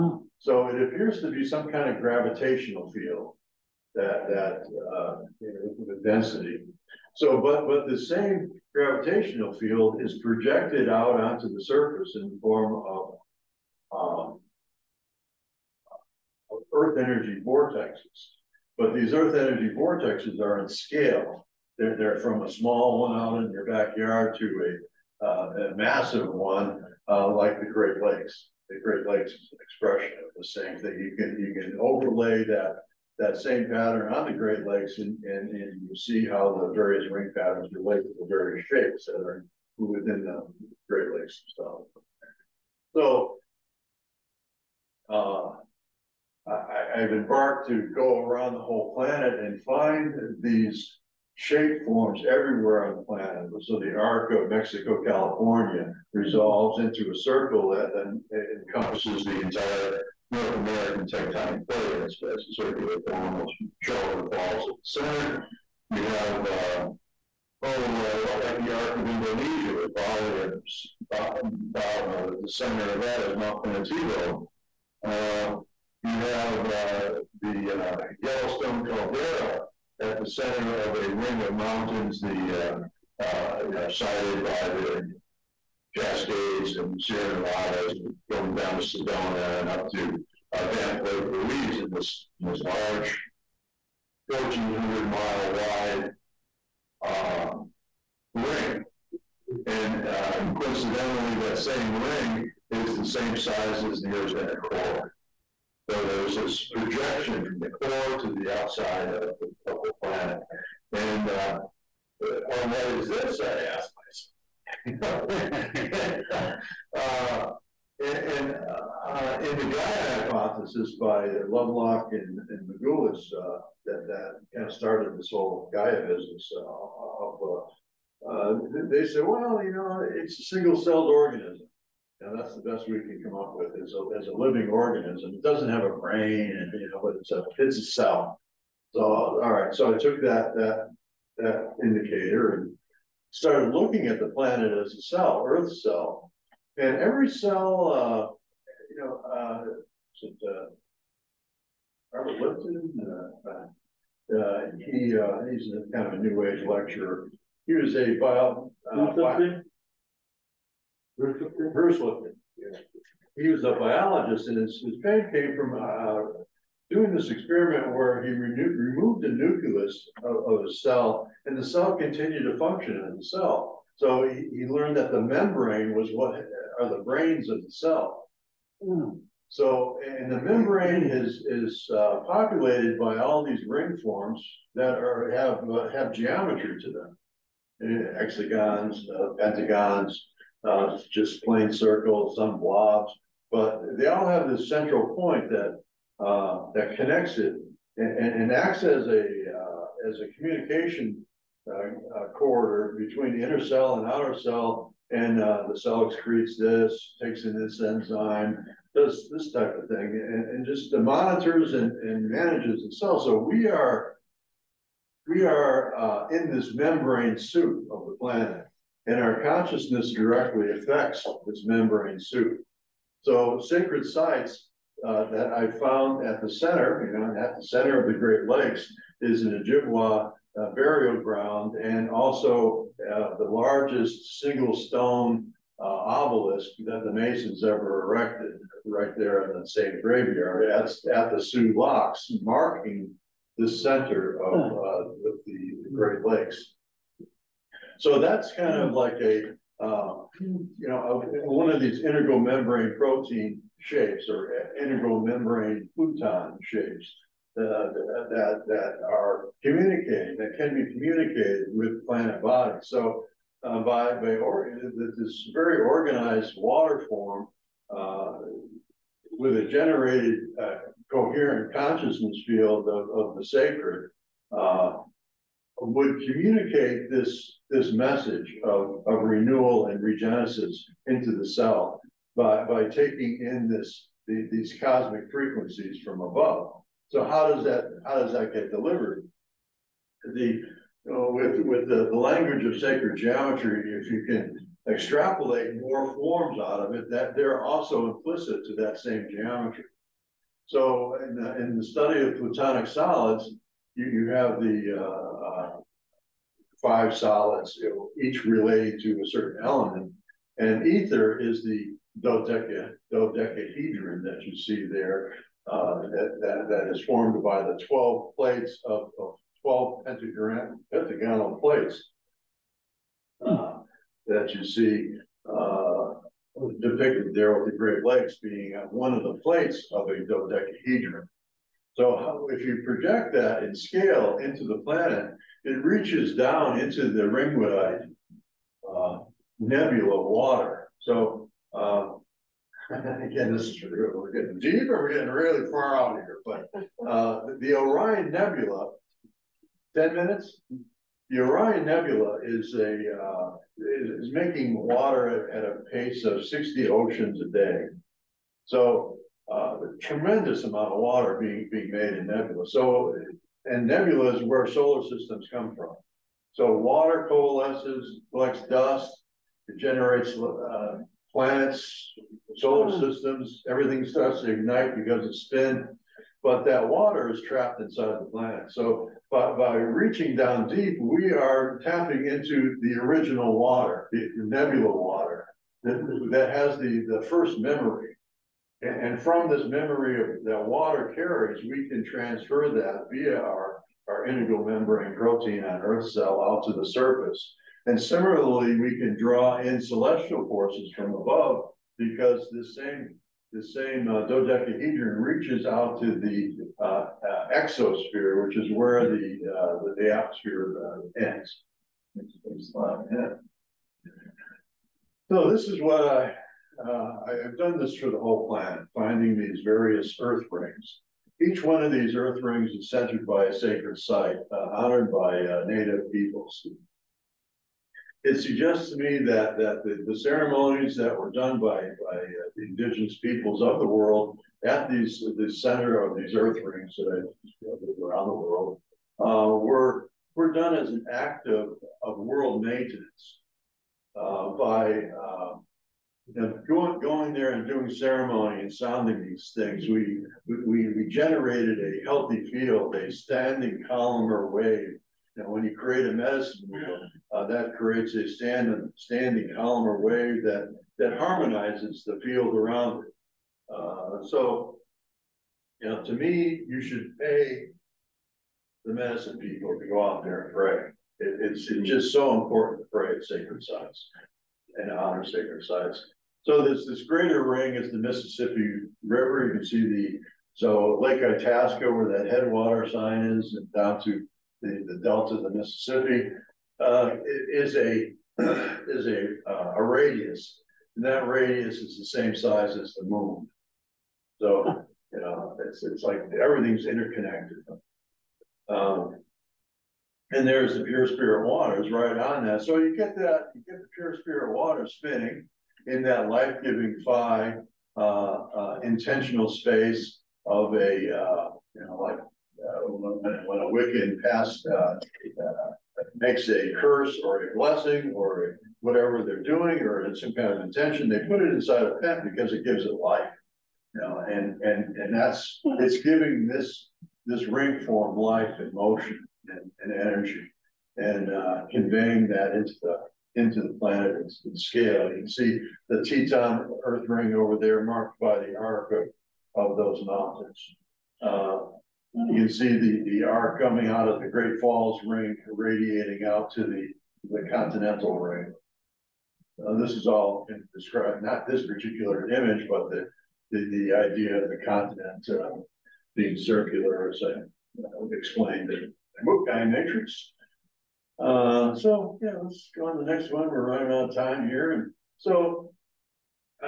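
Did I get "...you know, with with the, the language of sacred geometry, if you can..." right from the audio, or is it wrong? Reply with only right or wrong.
right.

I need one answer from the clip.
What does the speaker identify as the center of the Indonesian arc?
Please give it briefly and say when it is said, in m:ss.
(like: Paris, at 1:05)
Mount Pinatubo, at 1:13.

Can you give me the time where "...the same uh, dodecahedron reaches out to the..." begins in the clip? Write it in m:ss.
6:43.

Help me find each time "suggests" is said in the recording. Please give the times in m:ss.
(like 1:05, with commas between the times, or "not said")
7:08.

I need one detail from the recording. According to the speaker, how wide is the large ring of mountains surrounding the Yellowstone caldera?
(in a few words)
1,400 miles.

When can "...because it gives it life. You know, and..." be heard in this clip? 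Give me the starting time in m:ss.
8:42.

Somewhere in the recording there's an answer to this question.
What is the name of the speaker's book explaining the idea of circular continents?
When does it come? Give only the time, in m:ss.
9:19.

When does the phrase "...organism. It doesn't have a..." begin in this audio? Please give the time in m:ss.
2:14.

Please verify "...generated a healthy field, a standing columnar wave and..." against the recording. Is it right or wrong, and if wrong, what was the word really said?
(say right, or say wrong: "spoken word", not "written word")
right.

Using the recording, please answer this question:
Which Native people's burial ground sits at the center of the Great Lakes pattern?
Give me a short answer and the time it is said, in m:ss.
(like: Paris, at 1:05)
Ojibwa, at 3:49.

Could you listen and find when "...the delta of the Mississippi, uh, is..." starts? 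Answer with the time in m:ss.
8:04.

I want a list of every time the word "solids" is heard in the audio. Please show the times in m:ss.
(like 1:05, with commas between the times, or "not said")
5:02, 5:07.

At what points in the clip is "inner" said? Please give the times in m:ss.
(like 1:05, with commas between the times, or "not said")
1:44, 3:23.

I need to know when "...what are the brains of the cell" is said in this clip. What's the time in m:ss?
2:56.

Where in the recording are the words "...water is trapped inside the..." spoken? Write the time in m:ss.
6:16.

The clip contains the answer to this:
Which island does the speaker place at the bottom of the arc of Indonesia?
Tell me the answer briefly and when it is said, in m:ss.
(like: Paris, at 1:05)
Bali, at 1:09.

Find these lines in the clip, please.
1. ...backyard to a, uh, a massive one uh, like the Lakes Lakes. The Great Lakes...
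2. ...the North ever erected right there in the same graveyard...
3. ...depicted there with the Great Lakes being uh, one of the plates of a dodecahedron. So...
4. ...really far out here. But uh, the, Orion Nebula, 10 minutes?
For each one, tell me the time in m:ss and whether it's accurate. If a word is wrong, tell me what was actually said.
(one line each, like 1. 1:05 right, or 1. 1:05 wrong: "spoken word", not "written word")
1. 0:23 wrong: "Great", not "Lakes"
2. 3:57 wrong: "Masons", not "North"
3. 5:26 right
4. 5:45 right.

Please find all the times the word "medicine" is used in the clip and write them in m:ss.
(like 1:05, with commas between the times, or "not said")
7:36, 7:48.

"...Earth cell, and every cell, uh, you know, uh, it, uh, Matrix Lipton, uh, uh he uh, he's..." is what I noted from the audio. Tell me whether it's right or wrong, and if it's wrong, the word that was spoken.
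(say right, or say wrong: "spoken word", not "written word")
wrong: "Robert", not "Matrix".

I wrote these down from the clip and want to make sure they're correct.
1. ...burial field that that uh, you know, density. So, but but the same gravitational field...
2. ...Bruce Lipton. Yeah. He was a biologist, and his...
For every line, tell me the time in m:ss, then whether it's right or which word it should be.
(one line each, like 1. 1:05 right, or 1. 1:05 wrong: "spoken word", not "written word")
1. 0:02 wrong: "gravitational", not "burial"
2. 2:41 right.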